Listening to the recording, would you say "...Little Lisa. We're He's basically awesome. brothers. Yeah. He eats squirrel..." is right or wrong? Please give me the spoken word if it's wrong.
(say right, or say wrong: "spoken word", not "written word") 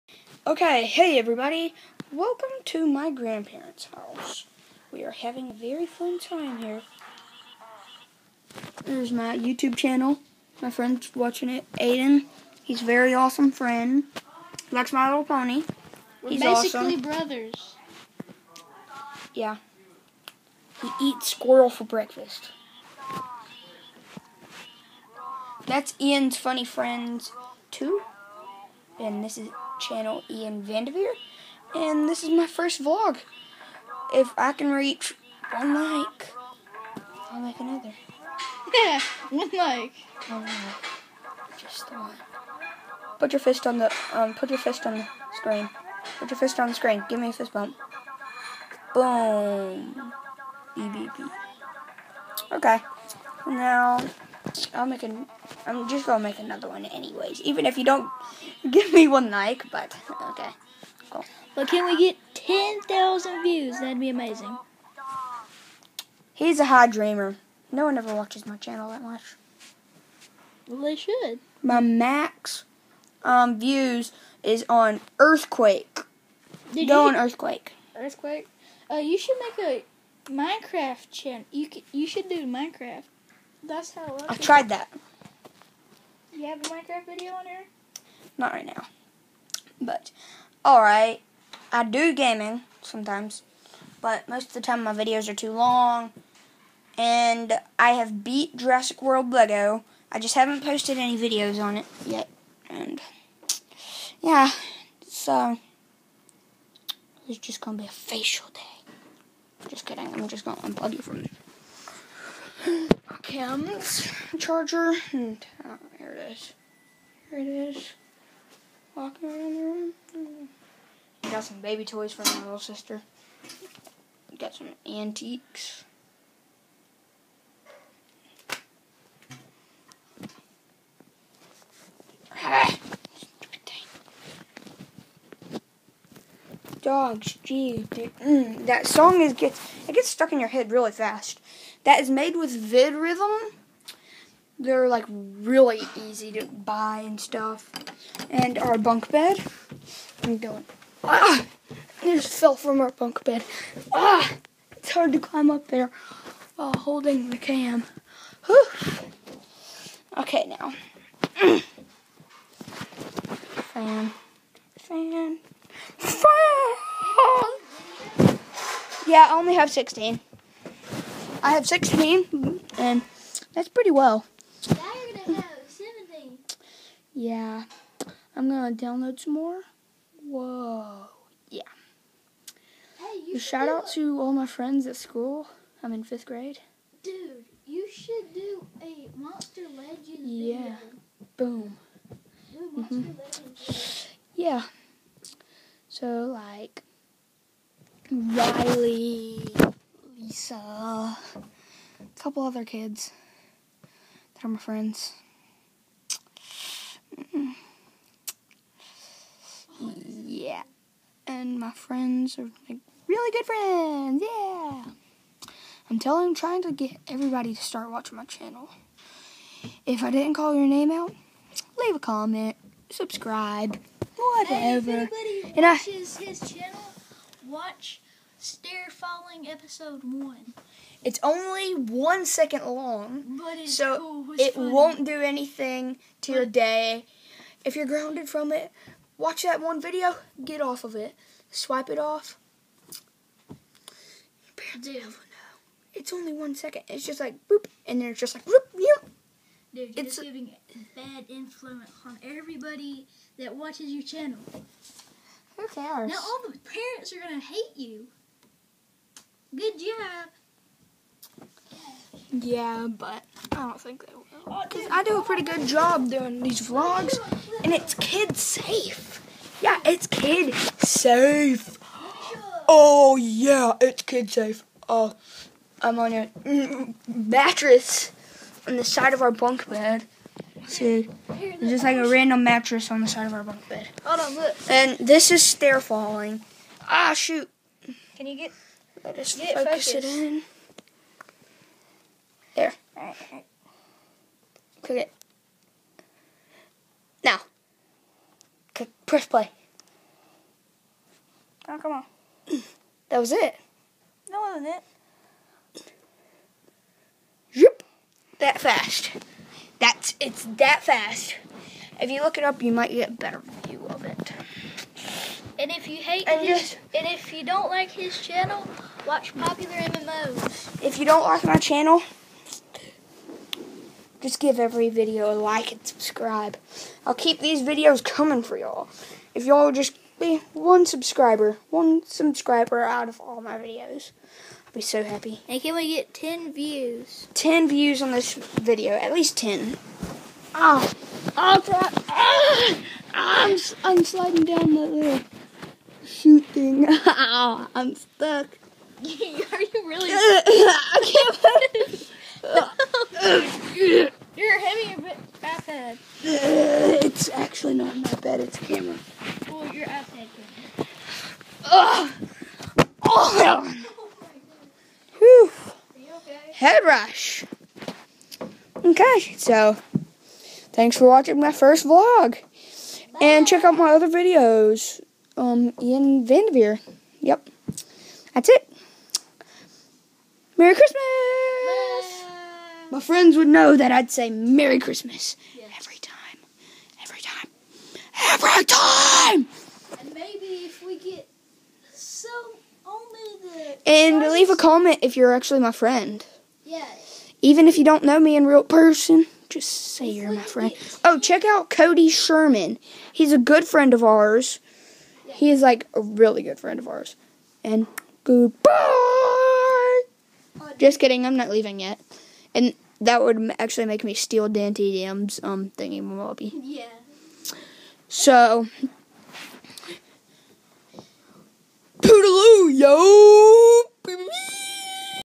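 wrong: "Pony", not "Lisa".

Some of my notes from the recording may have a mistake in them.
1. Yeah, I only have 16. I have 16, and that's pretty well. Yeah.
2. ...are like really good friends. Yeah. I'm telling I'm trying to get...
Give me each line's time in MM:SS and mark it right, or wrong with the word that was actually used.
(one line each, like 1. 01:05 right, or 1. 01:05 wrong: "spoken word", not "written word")
1. 02:49 right
2. 03:32 right.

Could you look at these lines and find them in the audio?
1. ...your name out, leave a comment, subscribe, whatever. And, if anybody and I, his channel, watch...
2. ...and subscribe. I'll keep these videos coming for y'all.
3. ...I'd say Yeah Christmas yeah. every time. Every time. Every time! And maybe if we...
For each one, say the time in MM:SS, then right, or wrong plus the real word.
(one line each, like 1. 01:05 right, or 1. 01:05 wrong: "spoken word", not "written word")
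1. 03:40 right
2. 05:25 right
3. 06:23 wrong: "Merry", not "Yeah".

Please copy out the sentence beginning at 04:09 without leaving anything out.
Dude, it's giving bad influence on everybody that watches your channel.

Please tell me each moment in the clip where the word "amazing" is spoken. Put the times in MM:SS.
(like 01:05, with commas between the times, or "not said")
01:04.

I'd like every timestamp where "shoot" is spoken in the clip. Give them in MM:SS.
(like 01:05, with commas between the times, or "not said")
04:47, 05:46.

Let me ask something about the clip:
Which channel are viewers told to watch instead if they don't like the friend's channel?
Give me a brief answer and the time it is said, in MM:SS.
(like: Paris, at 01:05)
Popular MMOs, at 05:19.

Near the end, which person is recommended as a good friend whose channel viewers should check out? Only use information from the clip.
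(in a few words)
Cody Sherman.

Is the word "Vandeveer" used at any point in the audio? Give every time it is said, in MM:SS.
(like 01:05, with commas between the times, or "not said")
00:30, 06:16.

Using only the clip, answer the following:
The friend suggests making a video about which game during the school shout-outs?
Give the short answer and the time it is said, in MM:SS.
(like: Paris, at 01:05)
Monster Legends, at 03:09.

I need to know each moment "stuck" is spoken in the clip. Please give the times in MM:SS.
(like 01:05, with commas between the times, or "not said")
02:20, 05:47.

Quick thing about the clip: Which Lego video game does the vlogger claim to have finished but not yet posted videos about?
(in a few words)
Jurassic World Lego.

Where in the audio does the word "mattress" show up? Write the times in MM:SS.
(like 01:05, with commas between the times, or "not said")
04:37, 04:42.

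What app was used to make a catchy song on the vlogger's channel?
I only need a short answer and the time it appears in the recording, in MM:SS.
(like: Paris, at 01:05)
VidRhythm, at 02:22.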